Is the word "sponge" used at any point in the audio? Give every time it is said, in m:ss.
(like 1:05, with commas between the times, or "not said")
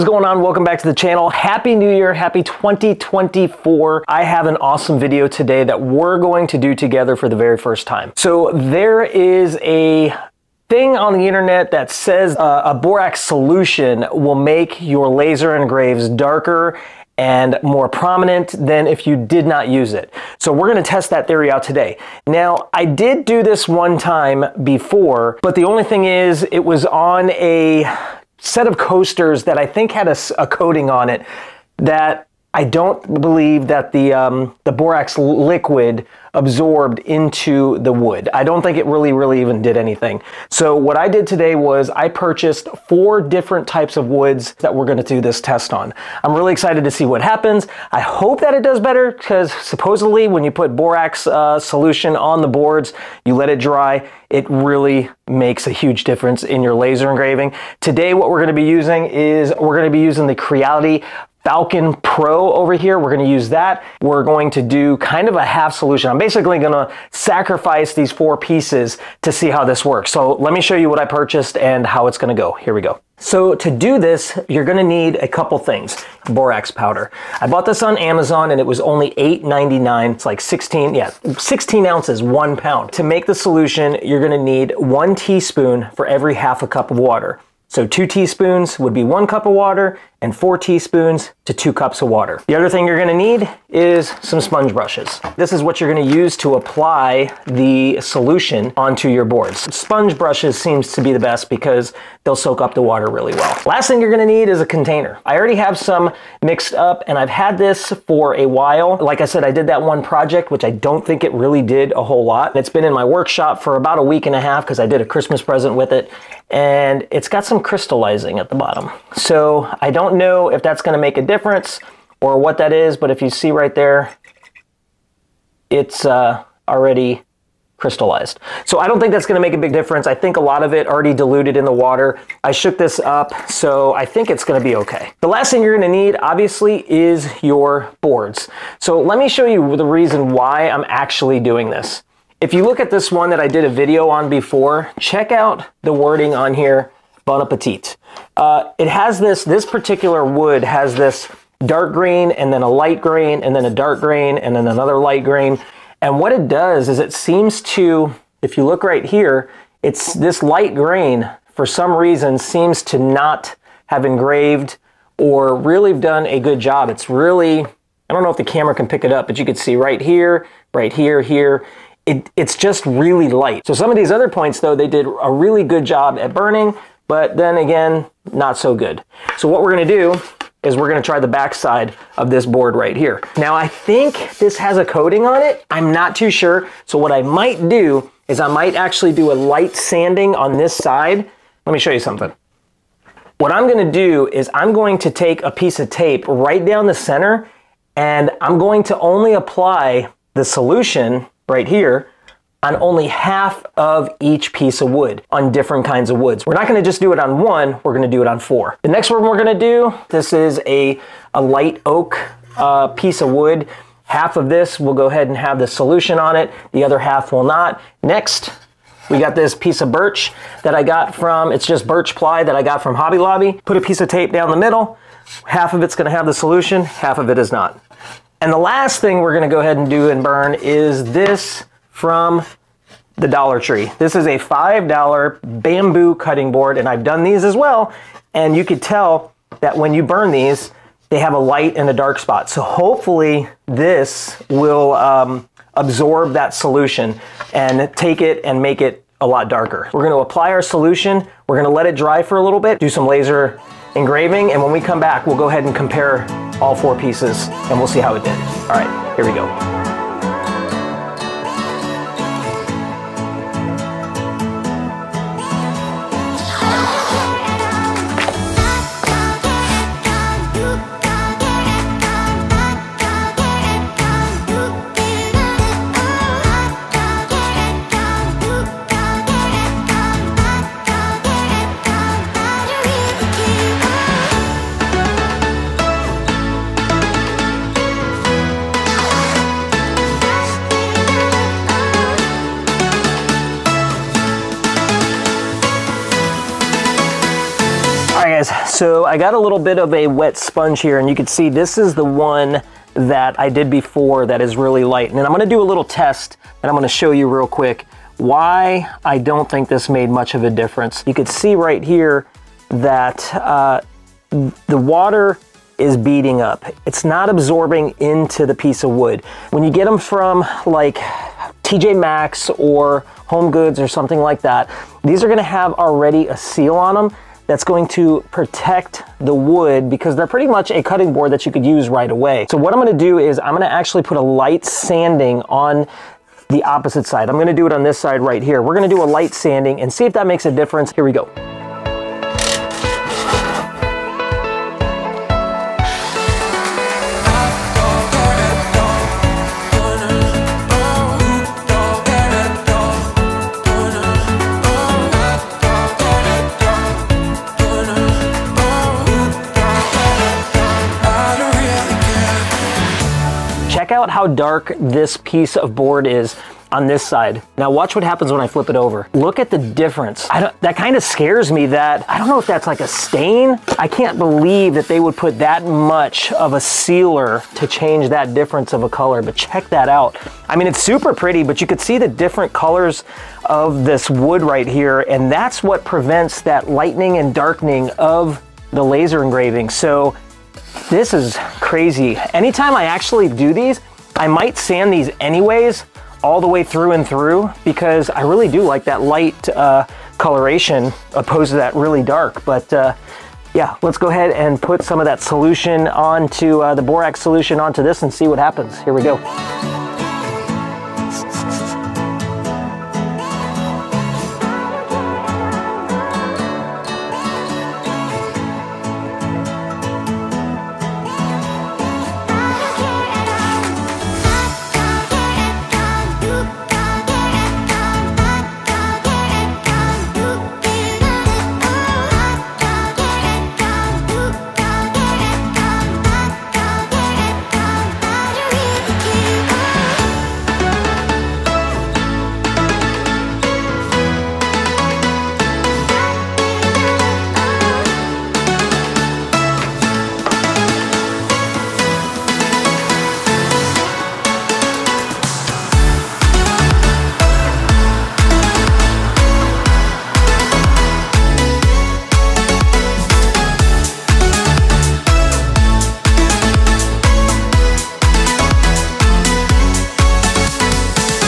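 1:34, 1:39, 5:00.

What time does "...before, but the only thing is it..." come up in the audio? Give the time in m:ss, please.
0:24.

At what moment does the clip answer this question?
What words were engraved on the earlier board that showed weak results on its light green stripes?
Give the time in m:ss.
2:27.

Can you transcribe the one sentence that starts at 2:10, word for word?
I think a lot of it already diluted in the water.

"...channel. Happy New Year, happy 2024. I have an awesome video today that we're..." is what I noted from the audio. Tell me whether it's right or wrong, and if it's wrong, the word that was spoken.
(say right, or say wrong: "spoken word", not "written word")
right.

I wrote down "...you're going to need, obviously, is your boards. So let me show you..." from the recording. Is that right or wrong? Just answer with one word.
right.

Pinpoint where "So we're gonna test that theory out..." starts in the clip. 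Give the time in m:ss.
0:20.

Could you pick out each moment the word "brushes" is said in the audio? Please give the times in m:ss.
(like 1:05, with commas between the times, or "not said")
1:34, 1:40.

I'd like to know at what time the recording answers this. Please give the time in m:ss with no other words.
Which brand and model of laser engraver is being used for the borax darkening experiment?
1:00.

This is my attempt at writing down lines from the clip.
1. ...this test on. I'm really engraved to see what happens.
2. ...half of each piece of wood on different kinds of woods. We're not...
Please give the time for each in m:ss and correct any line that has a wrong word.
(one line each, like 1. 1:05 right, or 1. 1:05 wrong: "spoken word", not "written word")
1. 0:45 wrong: "excited", not "engraved"
2. 3:23 right.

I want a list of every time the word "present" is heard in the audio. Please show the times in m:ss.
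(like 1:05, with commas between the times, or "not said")
1:55.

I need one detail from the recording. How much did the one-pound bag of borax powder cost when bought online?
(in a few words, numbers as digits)
$8.99.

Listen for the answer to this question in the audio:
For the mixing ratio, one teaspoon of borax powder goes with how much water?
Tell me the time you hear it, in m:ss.
1:26.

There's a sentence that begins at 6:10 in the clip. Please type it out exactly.
that kind of scares me that, I don't know if that's like a stain.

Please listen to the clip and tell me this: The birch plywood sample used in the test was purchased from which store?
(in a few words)
Hobby Lobby.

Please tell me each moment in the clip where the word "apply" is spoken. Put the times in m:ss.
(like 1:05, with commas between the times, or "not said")
1:36, 3:19, 4:10.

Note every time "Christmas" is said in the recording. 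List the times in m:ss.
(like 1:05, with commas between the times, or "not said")
1:55.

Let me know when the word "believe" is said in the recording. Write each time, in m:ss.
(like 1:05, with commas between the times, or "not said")
0:33, 6:14.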